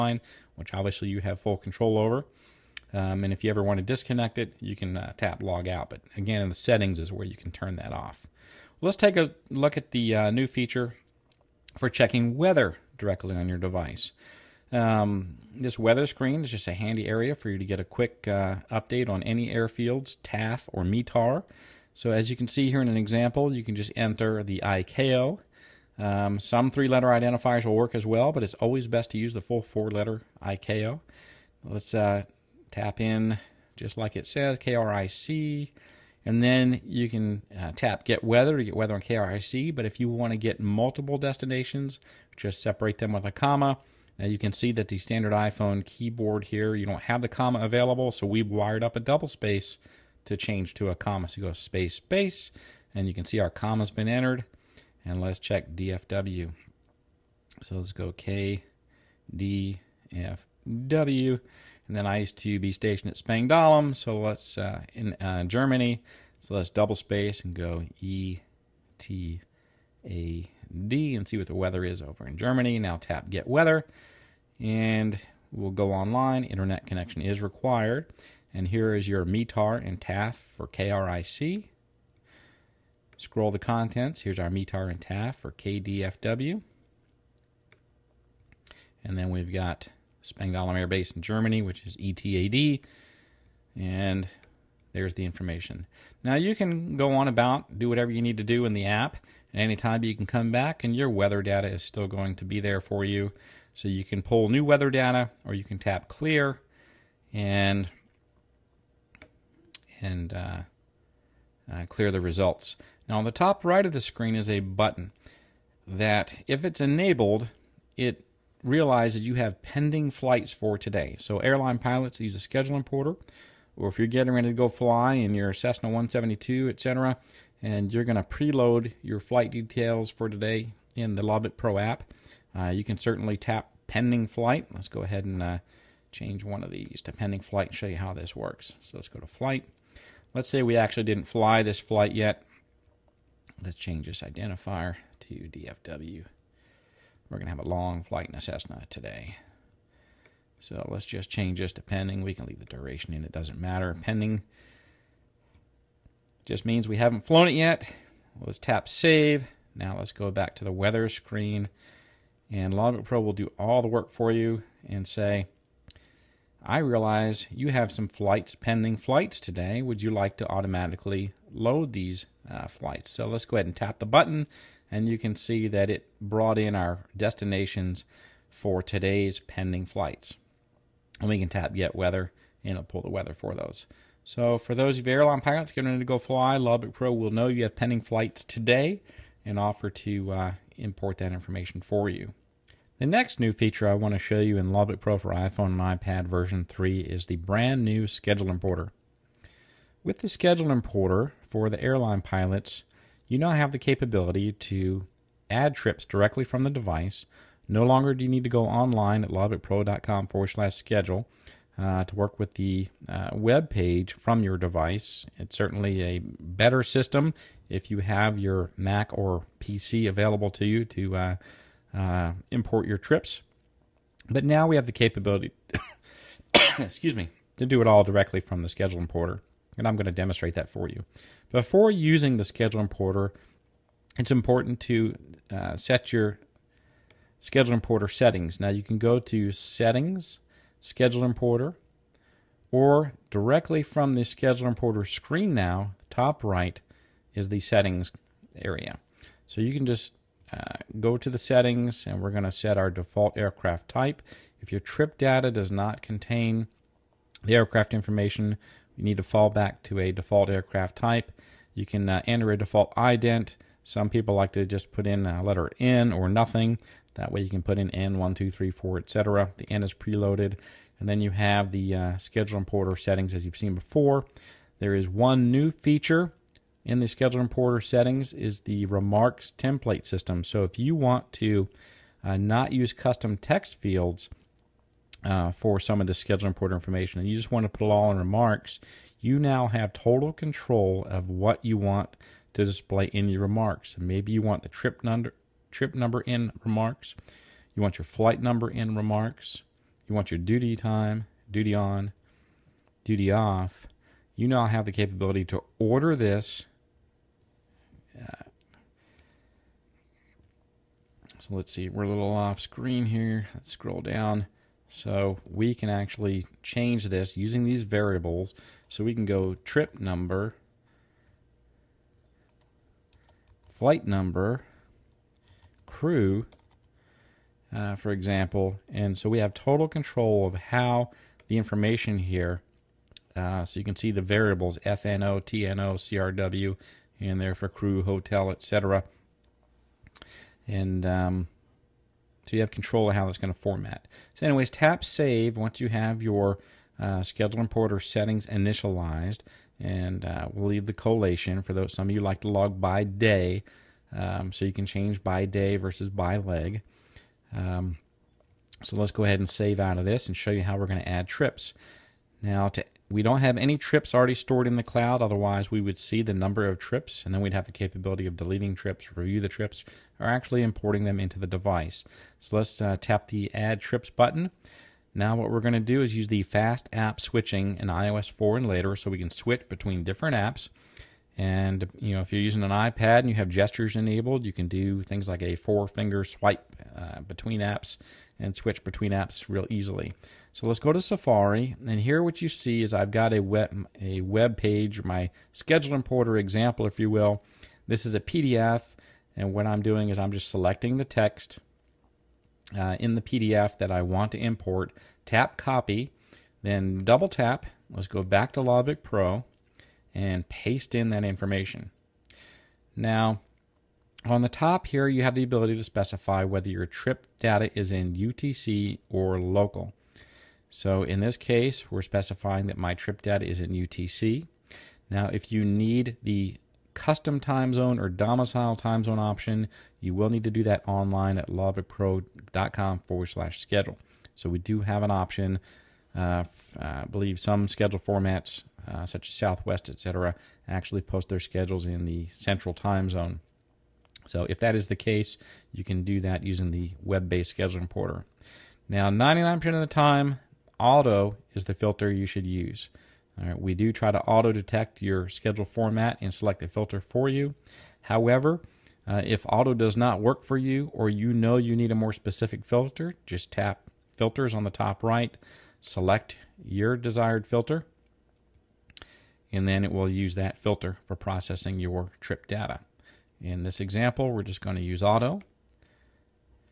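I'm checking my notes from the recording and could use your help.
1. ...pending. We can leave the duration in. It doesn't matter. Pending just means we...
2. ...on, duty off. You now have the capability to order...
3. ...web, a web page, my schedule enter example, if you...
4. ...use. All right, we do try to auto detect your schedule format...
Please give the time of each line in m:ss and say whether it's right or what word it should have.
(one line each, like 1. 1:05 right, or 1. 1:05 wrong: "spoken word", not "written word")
1. 2:31 right
2. 5:01 right
3. 6:33 wrong: "importer", not "enter"
4. 7:32 right.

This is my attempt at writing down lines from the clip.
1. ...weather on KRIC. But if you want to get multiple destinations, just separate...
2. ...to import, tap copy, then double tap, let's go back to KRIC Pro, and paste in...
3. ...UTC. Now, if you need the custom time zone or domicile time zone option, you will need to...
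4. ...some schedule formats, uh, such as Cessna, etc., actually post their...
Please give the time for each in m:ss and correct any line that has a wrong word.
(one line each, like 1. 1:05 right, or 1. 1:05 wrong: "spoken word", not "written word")
1. 0:38 right
2. 6:44 wrong: "Logbook", not "KRIC"
3. 7:03 right
4. 7:17 wrong: "Southwest", not "Cessna".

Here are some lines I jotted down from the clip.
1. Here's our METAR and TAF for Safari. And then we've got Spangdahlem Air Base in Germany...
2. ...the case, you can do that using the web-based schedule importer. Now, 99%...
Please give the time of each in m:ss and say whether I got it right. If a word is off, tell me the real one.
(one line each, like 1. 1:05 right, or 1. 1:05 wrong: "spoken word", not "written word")
1. 1:24 wrong: "KDFW", not "Safari"
2. 7:24 right.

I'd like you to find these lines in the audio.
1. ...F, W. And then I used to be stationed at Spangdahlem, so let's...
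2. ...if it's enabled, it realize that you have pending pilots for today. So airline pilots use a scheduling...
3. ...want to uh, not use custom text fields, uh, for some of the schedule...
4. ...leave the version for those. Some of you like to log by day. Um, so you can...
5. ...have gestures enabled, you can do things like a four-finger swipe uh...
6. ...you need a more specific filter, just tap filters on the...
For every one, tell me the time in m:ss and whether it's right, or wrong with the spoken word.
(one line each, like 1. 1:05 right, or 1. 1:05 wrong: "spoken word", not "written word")
1. 1:00 right
2. 1:56 wrong: "flights", not "pilots"
3. 4:40 right
4. 5:50 wrong: "collation", not "version"
5. 6:23 right
6. 7:41 right.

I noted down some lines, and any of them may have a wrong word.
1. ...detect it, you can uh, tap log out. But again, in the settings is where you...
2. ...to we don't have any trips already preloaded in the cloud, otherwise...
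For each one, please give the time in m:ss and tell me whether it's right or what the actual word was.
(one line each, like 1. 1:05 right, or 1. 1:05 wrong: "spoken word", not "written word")
1. 0:03 wrong: "disconnect", not "detect"
2. 6:02 wrong: "stored", not "preloaded".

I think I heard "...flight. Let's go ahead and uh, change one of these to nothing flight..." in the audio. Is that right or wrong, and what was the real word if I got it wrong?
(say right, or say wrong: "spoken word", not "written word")
wrong: "pending", not "nothing".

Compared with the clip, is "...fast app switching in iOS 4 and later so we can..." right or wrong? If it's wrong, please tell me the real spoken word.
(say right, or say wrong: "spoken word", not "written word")
right.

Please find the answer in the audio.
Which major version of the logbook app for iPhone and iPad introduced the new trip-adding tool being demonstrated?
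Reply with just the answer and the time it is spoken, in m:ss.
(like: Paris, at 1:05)
Version 3, at 3:16.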